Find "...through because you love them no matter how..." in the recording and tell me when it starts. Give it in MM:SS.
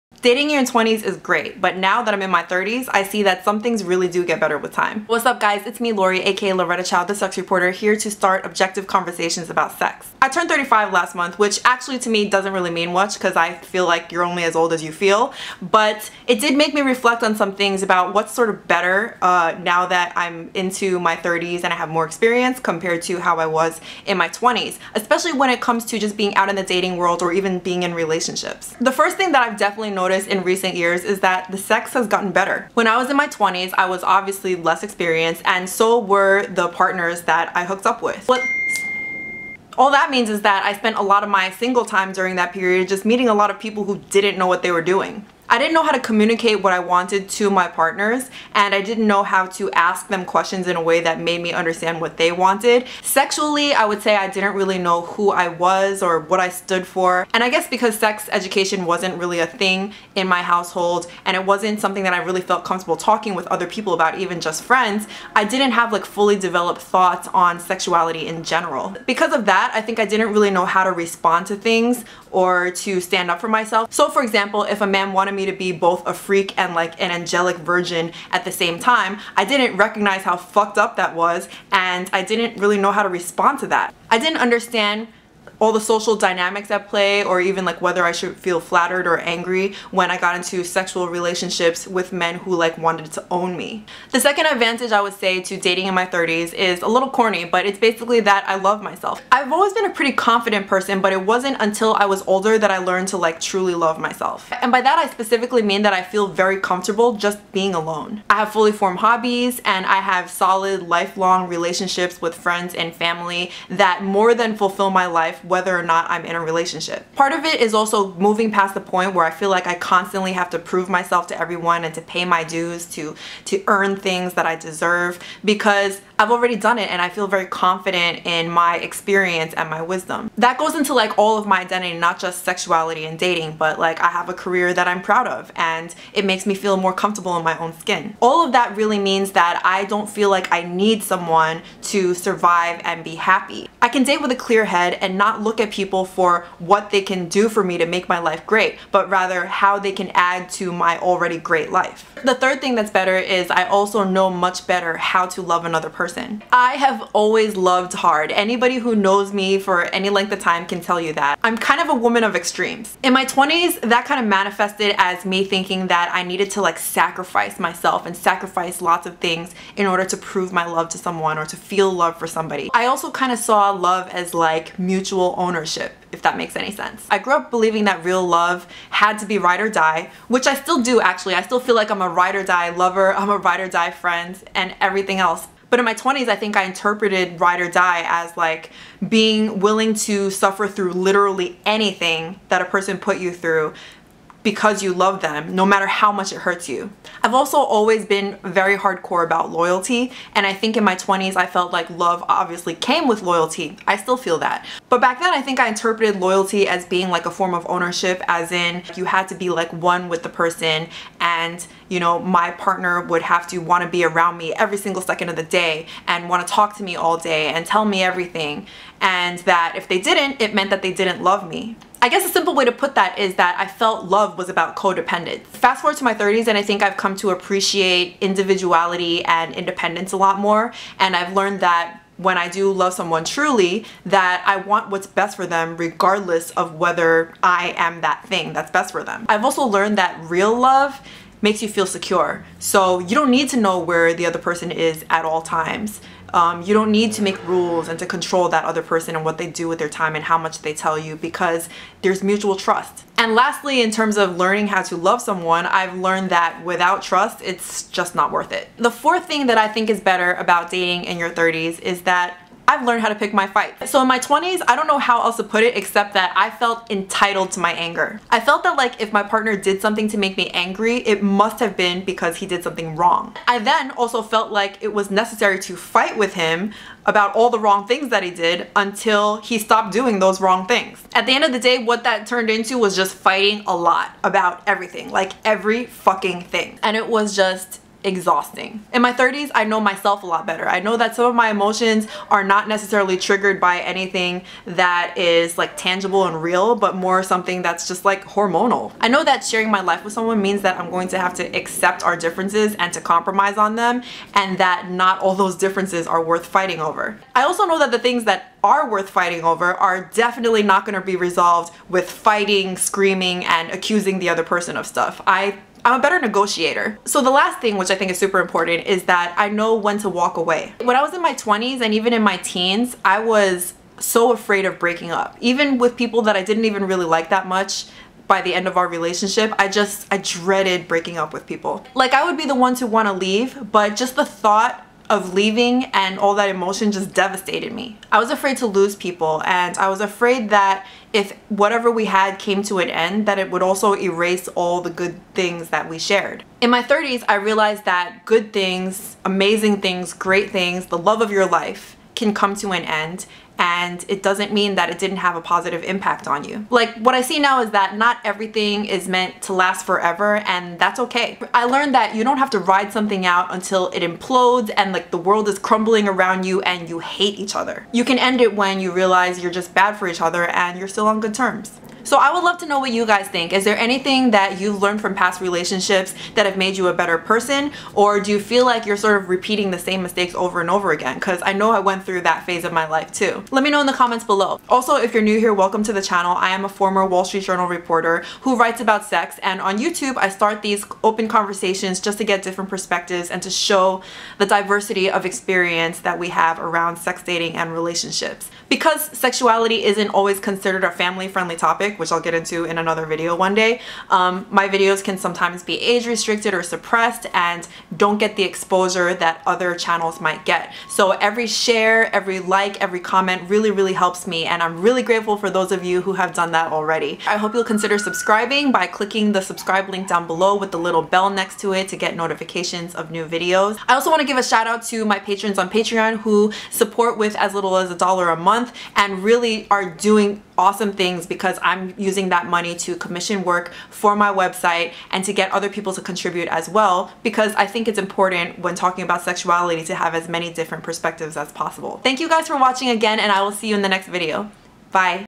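03:13.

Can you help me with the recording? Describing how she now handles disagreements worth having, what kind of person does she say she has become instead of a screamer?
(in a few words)
A better negotiator.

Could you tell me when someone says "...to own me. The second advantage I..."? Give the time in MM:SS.
01:33.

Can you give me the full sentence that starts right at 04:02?
So you don't need to know where the other person is at all times.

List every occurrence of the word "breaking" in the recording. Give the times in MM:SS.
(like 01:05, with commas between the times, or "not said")
05:24, 05:30.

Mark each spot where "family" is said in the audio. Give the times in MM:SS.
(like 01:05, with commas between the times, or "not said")
01:52, 06:40.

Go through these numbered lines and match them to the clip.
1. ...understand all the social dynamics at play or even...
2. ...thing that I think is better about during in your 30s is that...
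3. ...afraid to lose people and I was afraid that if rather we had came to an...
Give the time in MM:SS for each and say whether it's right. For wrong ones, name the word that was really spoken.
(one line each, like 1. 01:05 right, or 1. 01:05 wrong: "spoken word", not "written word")
1. 01:24 right
2. 04:19 wrong: "dating", not "during"
3. 05:38 wrong: "whatever", not "rather".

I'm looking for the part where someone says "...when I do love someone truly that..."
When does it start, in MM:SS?
03:52.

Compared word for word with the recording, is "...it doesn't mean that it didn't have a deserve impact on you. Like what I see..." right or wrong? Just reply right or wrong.
wrong.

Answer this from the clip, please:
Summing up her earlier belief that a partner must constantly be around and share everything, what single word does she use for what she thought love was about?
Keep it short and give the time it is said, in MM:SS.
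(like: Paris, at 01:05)
Codependence, at 03:44.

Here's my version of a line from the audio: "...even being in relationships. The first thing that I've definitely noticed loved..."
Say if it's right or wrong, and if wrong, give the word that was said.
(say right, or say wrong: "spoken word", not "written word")
wrong: "noticed", not "loved".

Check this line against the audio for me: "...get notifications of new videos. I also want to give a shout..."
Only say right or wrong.
right.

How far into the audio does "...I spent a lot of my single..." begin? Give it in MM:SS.
00:40.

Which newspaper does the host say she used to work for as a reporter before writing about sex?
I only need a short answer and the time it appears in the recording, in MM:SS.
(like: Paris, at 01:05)
Wall Street Journal, at 06:27.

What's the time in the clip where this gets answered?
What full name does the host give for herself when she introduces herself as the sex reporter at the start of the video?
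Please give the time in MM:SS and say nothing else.
00:06.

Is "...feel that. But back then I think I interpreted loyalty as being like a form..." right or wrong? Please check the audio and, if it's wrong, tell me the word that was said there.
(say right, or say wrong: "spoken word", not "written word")
right.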